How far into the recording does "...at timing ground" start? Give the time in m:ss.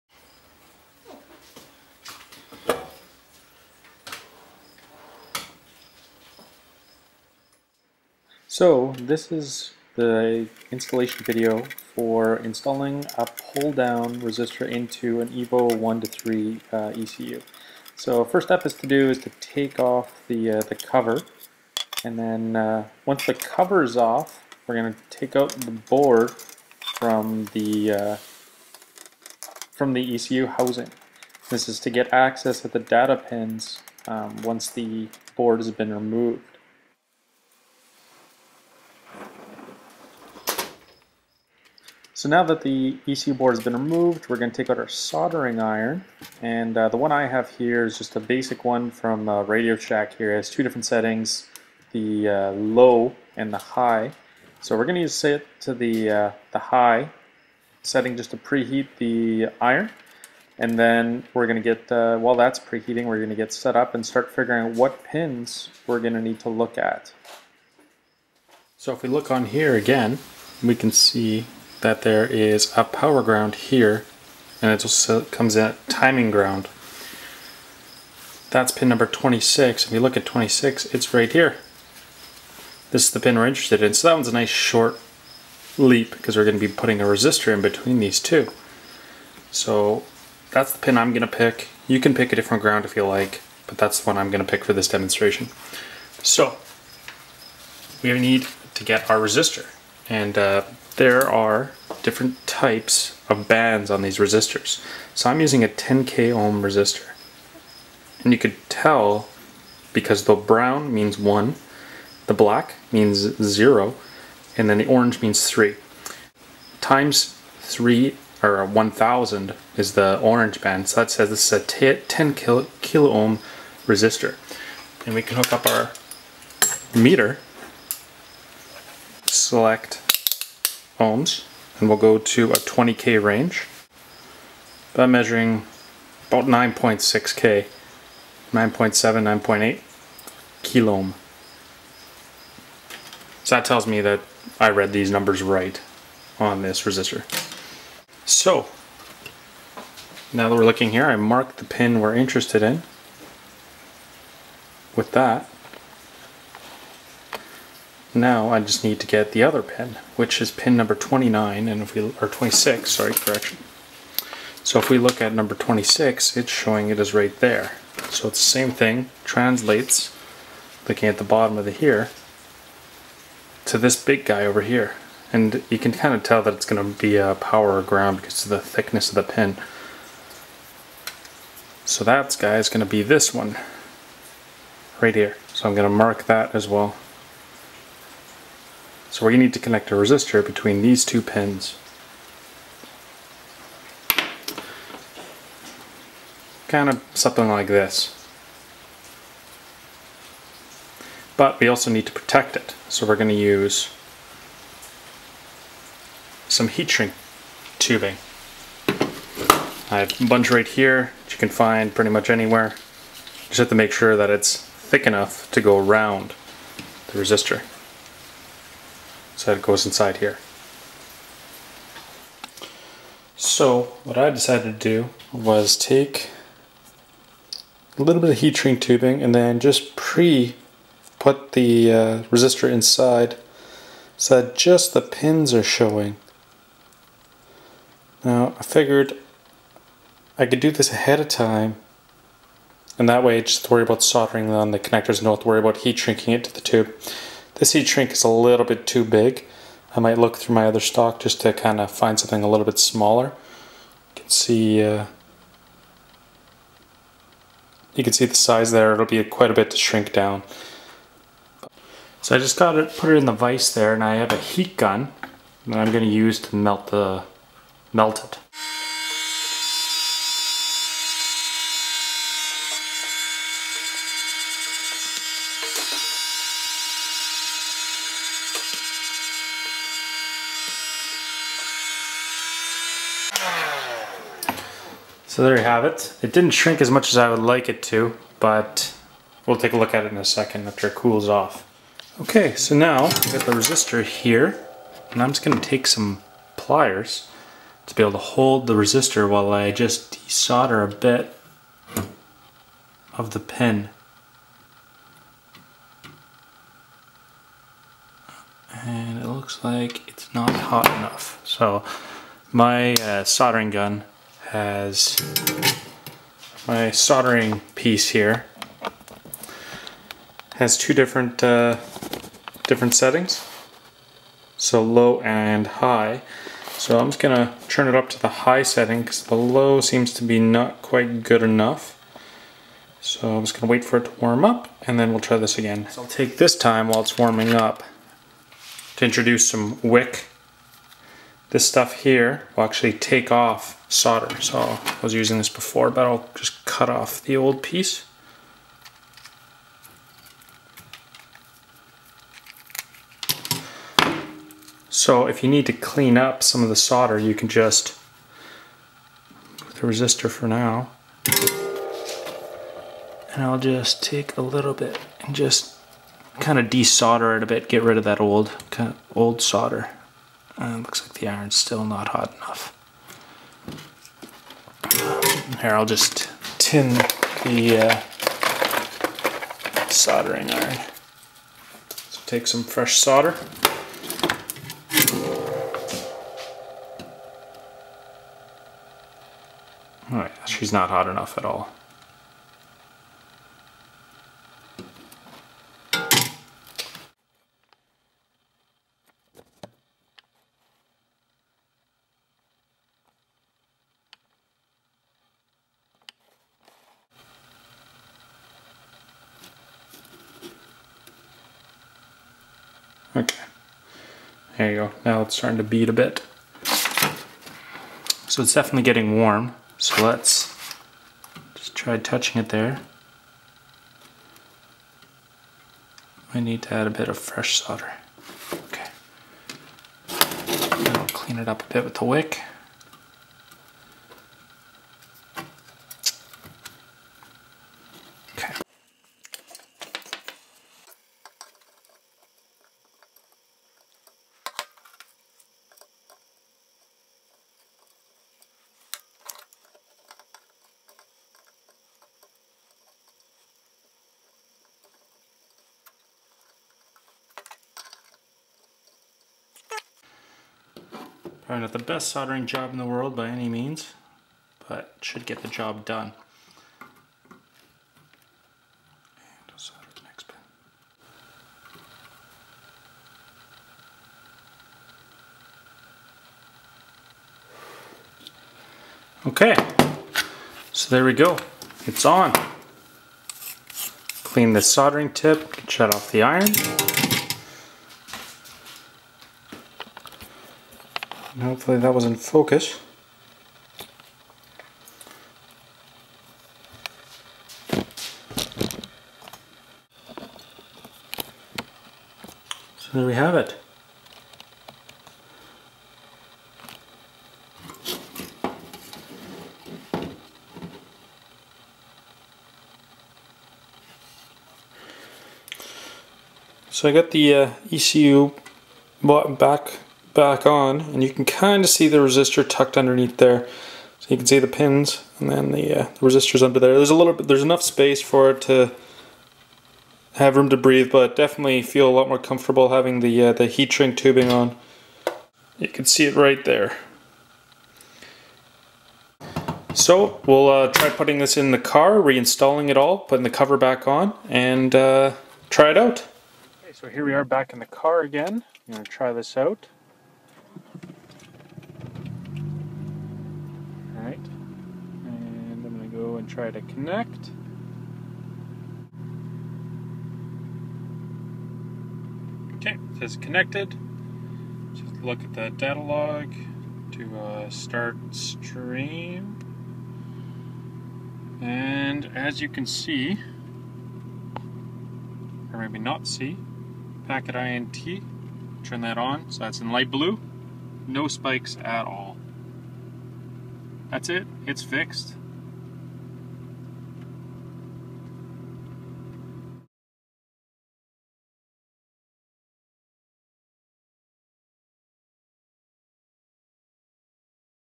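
1:15.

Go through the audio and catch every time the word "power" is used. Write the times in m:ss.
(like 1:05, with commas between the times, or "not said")
1:12, 2:57.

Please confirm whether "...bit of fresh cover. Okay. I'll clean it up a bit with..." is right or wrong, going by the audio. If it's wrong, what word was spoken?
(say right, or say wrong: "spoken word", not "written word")
wrong: "solder", not "cover".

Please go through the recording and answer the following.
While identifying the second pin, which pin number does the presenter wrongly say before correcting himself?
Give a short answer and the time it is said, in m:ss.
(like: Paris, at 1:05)
29, at 2:40.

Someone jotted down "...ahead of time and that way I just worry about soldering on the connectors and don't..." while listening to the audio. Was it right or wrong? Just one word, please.
right.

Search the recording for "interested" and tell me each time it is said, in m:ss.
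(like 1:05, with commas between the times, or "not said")
1:23, 2:32.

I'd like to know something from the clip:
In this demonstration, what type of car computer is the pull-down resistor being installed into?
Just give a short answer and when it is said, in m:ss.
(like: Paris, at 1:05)
EVO 1 to 3 ECU, at 0:15.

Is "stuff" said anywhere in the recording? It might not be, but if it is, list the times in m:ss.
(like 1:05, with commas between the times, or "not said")
5:41.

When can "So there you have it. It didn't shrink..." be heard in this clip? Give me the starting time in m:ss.
4:45.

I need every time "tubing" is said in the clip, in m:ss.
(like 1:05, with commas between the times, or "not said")
3:27, 3:48, 8:53.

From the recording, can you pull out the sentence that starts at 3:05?
So I'm going to mark that as well.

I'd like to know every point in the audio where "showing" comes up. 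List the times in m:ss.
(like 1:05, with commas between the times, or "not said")
2:46, 3:55.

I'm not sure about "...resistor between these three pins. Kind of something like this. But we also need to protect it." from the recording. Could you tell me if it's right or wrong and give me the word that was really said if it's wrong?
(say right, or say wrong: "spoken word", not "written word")
wrong: "two", not "three".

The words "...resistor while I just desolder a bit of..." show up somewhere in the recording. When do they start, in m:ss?
4:58.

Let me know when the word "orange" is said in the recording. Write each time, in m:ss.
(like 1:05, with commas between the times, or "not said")
1:54, 2:00.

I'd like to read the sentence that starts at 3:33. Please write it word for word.
Just have to make sure that it's thick enough to go around the resistor.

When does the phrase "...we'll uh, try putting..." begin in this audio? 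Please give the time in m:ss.
9:00.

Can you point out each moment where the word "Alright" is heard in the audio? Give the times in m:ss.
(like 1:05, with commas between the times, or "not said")
6:30.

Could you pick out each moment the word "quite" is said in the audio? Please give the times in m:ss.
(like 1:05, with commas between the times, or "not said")
4:19, 5:30.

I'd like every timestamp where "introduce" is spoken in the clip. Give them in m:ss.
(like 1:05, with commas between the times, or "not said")
5:39.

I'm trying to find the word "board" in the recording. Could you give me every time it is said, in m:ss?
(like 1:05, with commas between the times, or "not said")
0:25, 0:35, 0:43.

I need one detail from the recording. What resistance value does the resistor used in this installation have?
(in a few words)
10k ohm.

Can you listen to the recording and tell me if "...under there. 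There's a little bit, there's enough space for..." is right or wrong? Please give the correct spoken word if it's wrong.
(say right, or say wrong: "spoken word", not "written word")
right.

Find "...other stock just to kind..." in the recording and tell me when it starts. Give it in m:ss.
4:10.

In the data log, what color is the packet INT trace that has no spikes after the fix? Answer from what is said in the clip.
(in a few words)
light blue.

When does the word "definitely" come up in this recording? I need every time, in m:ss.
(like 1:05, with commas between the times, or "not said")
6:58, 8:51.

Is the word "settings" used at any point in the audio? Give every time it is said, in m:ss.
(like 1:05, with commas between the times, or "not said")
0:50, 0:57, 5:22, 5:28.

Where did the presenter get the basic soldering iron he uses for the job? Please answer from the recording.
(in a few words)
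Radio Shack.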